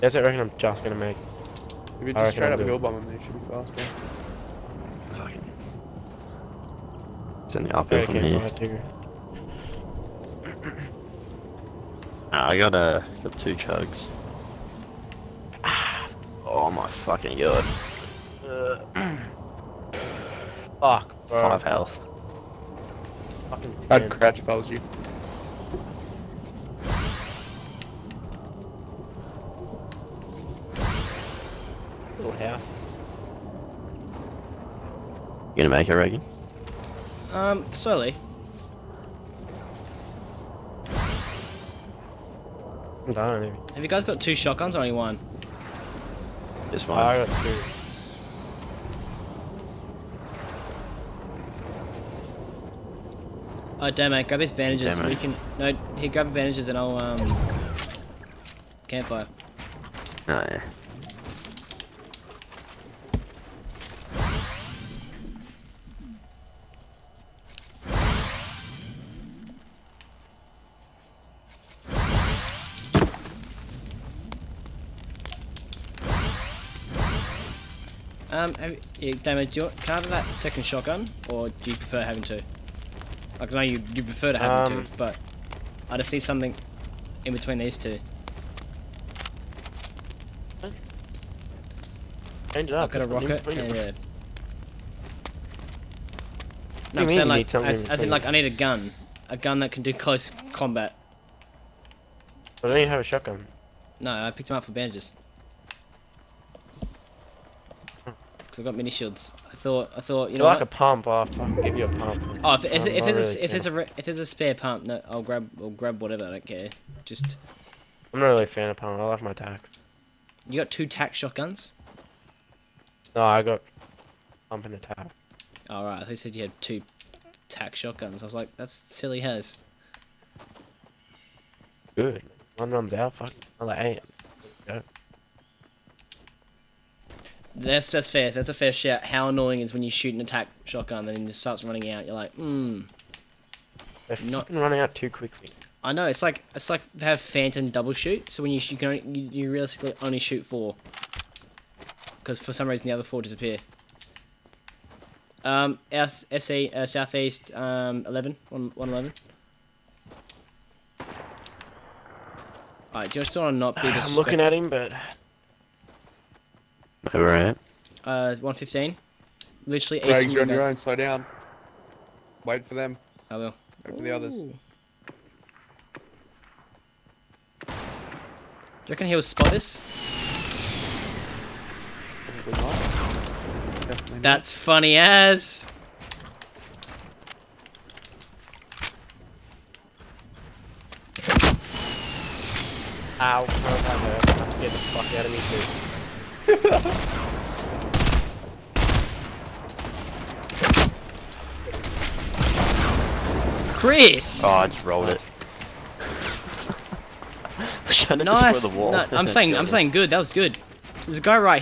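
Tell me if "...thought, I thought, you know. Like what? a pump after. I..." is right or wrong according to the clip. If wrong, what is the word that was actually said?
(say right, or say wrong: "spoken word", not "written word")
right.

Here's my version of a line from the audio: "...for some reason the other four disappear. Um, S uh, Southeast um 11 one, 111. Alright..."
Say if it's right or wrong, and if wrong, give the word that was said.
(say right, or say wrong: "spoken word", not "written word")
right.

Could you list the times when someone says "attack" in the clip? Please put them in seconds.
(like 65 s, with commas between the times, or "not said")
124 s, 140 s.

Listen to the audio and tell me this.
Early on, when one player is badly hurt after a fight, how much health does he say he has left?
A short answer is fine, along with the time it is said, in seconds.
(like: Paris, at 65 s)
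5, at 21 s.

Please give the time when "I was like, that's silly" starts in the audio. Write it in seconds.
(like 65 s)
128 s.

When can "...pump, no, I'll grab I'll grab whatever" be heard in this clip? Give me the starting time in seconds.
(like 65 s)
114 s.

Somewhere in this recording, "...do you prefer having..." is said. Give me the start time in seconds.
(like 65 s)
81 s.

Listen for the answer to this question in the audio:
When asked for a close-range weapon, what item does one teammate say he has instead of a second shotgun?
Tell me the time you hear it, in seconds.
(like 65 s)
93 s.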